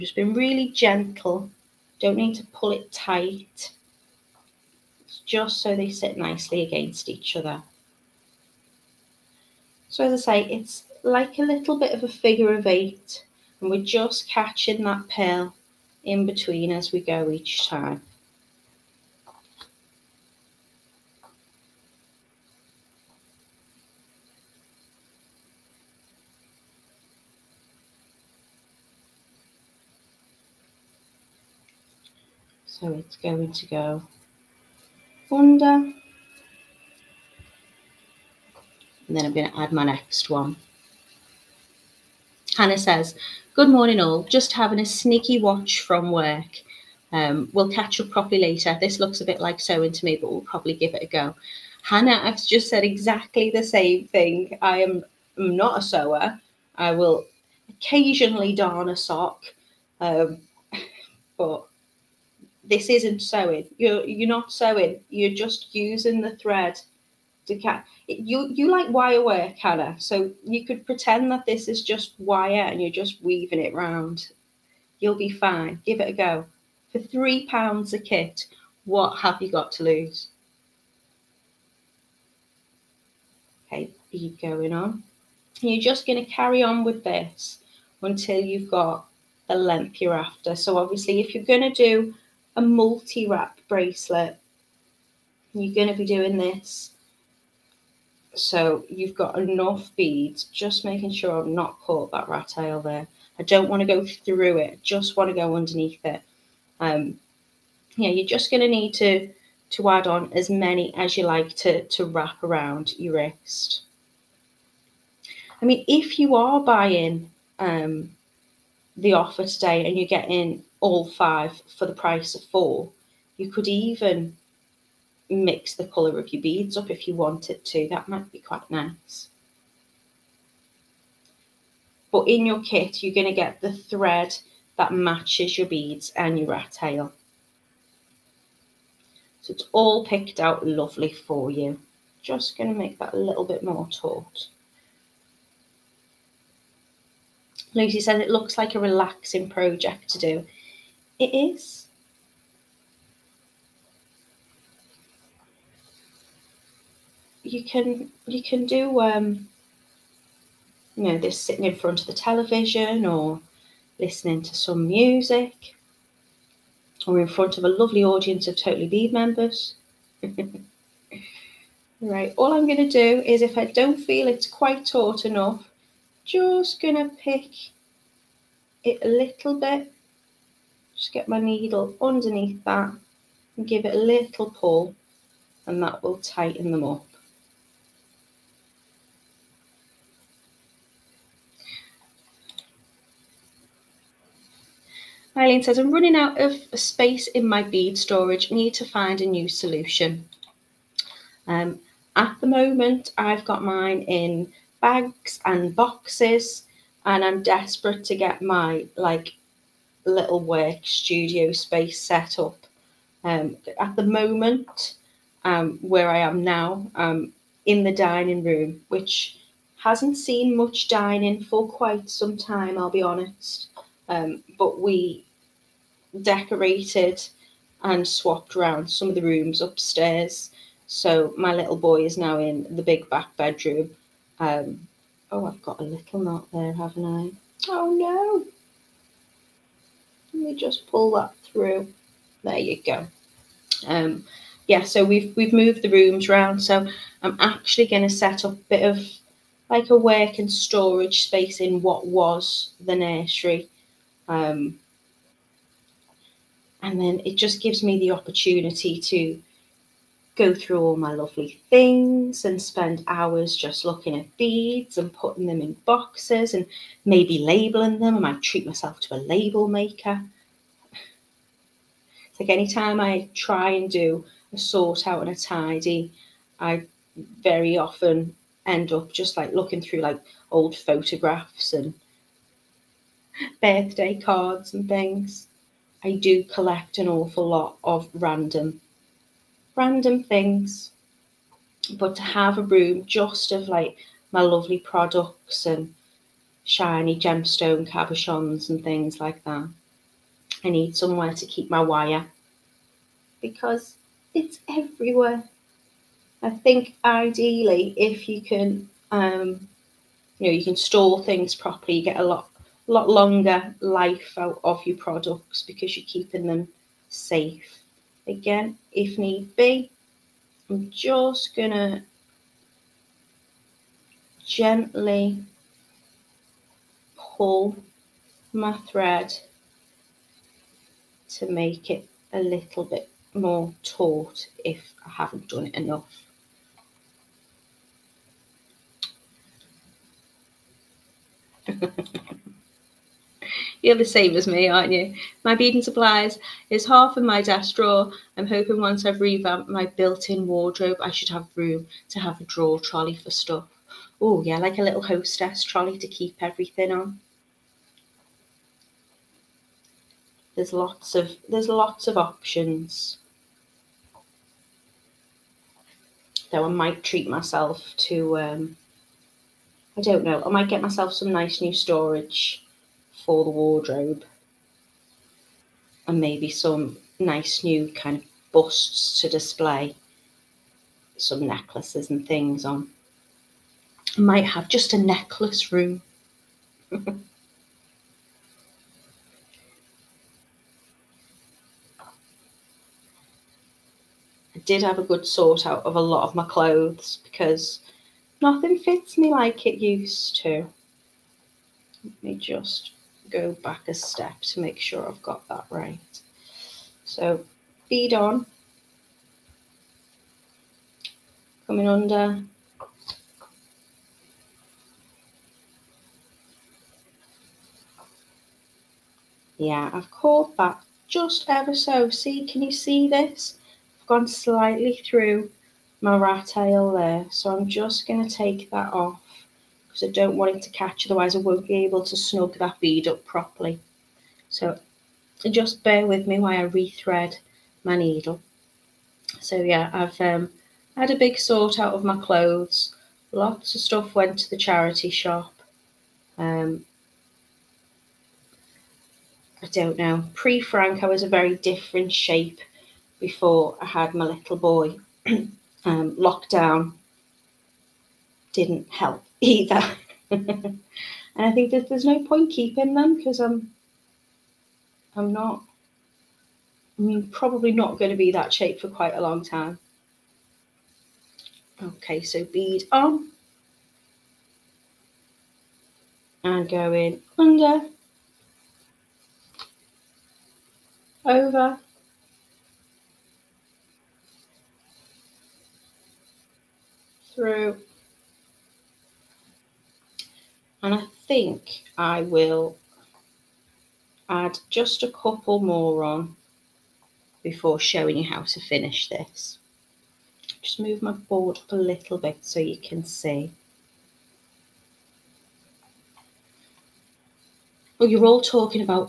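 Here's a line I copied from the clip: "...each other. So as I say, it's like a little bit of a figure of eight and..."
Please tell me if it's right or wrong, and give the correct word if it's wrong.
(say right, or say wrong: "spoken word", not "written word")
right.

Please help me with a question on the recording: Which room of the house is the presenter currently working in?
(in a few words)
The dining room.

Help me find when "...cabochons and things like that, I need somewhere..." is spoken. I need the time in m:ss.
4:57.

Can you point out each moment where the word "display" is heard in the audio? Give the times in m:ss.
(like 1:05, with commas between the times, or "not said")
6:19.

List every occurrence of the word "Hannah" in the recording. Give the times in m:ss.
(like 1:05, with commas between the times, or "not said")
0:42, 0:51, 1:09.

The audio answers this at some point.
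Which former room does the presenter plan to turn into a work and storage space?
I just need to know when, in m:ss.
4:12.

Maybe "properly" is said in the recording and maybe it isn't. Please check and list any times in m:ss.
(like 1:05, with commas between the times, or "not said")
0:48, 5:11, 7:13.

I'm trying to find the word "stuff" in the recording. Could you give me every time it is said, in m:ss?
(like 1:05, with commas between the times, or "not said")
5:53, 7:23.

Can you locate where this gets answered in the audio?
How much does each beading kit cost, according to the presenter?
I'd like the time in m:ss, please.
1:16.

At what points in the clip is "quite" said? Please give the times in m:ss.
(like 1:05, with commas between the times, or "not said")
2:08, 2:54, 3:41, 7:48.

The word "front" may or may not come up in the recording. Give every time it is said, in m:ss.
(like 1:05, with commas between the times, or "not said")
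2:41, 2:47.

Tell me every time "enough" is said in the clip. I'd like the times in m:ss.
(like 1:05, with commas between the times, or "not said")
1:39, 2:55, 5:35.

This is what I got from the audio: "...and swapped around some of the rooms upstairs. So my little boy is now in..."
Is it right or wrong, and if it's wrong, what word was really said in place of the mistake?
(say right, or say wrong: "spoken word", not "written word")
right.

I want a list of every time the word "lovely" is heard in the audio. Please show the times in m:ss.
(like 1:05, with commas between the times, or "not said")
2:20, 2:47, 4:21, 4:54.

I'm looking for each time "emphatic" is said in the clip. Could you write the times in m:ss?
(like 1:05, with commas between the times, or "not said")
not said.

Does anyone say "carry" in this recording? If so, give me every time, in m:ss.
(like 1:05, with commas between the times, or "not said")
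1:26.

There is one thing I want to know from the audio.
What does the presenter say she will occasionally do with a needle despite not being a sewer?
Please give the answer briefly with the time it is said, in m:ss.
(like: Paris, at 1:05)
Darn a sock, at 0:58.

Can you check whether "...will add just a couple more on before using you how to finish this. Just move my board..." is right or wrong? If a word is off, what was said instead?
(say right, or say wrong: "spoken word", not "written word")
wrong: "showing", not "using".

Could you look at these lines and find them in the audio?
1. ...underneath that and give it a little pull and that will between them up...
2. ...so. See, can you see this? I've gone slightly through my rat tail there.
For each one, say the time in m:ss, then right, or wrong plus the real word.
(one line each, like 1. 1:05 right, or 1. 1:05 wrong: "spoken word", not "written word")
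1. 3:02 wrong: "tighten", not "between"
2. 7:01 right.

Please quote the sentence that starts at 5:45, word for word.
My beading supplies is half of my desk drawer.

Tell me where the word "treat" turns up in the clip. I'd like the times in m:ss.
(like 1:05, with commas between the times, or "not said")
4:28, 6:07.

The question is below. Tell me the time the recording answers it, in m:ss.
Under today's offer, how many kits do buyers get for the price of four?
2:00.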